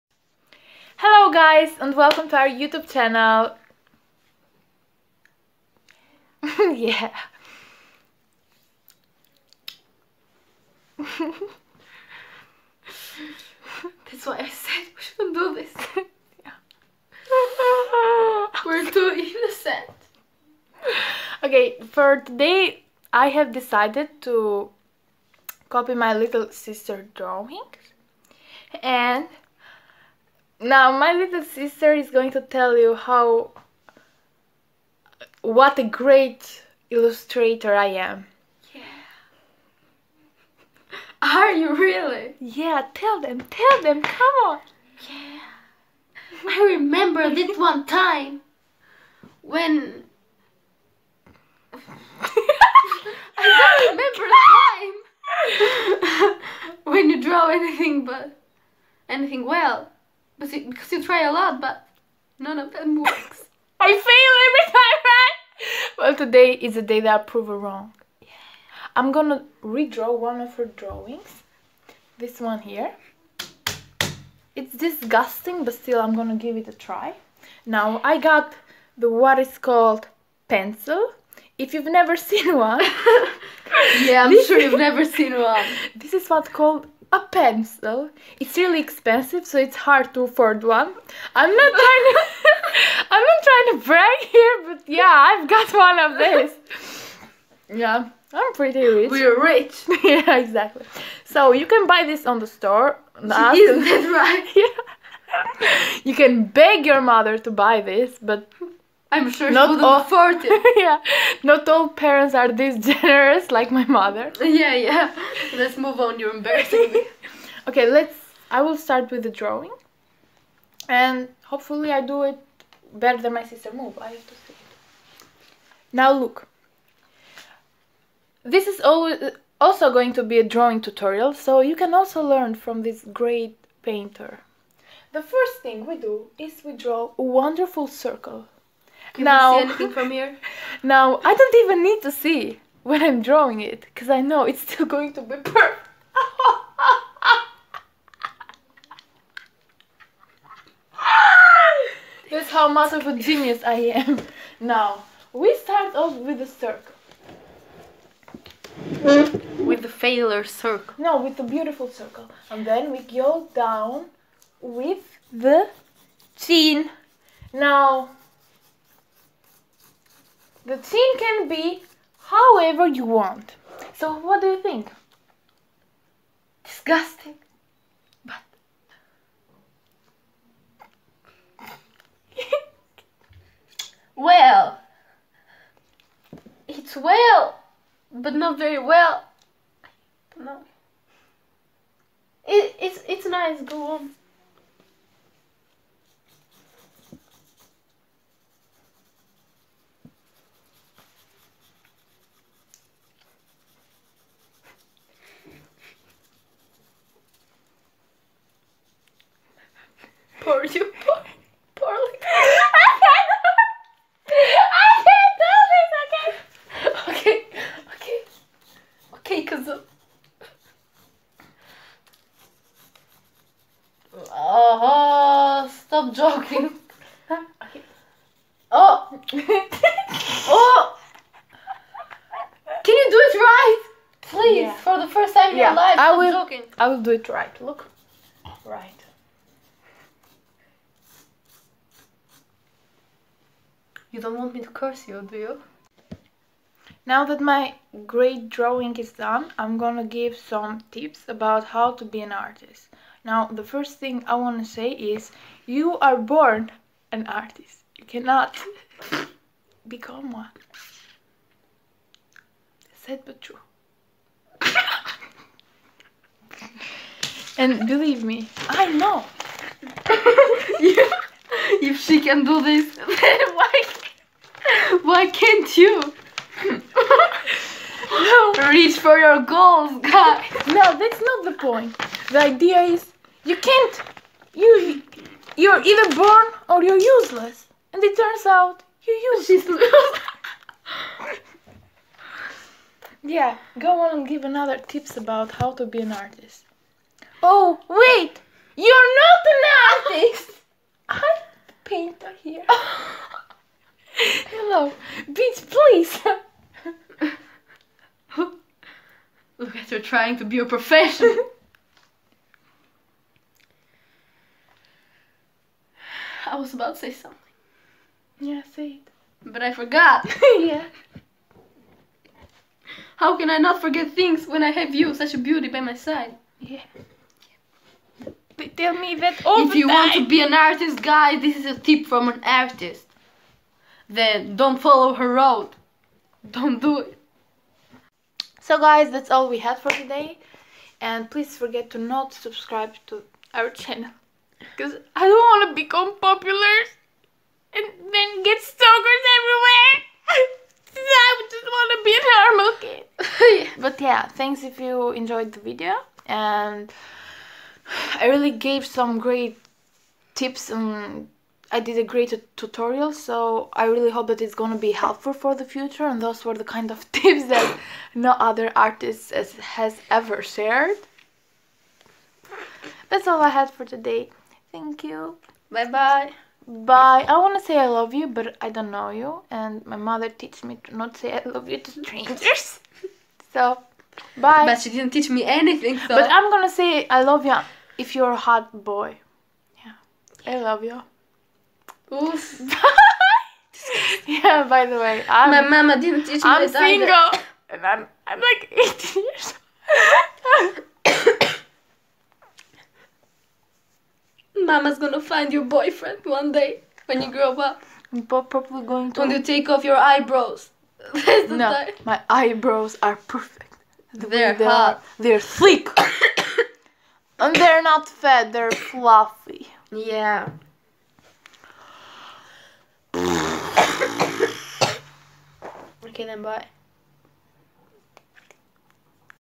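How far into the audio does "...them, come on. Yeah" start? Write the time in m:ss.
0:43.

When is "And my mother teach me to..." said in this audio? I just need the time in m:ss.
6:19.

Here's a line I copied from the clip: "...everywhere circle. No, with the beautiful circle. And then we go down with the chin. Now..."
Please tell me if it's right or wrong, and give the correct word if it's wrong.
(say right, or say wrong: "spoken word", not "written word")
wrong: "failure", not "everywhere".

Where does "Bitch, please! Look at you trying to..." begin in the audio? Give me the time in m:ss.
5:05.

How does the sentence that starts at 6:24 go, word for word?
But she didn't teach me anything.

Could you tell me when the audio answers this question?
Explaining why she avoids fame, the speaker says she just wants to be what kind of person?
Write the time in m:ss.
5:52.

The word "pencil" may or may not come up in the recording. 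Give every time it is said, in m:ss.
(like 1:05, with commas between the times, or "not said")
1:20, 1:27.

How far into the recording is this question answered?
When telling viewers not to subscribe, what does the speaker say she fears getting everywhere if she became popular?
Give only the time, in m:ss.
5:48.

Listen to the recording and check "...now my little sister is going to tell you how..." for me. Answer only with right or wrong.
right.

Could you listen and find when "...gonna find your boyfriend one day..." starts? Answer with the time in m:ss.
6:44.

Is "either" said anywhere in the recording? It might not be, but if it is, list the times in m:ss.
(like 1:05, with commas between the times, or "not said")
4:45, 6:37.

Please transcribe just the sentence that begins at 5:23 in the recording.
How can I not forget things when I have you, such a beauty, by my side?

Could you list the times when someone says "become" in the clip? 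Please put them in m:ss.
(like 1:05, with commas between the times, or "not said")
4:19, 5:45.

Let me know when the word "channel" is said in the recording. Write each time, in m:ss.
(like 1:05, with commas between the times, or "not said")
0:02, 5:43.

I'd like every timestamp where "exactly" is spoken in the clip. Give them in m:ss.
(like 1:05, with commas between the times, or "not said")
1:40.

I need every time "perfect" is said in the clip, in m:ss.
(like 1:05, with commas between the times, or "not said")
2:25, 6:53.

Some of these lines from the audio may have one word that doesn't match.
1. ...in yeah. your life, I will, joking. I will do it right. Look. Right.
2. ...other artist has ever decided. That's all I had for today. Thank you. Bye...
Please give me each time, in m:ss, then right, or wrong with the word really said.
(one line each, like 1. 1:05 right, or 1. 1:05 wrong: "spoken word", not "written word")
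1. 3:55 right
2. 6:08 wrong: "shared", not "decided".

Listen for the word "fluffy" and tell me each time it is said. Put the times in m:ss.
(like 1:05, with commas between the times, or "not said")
6:58.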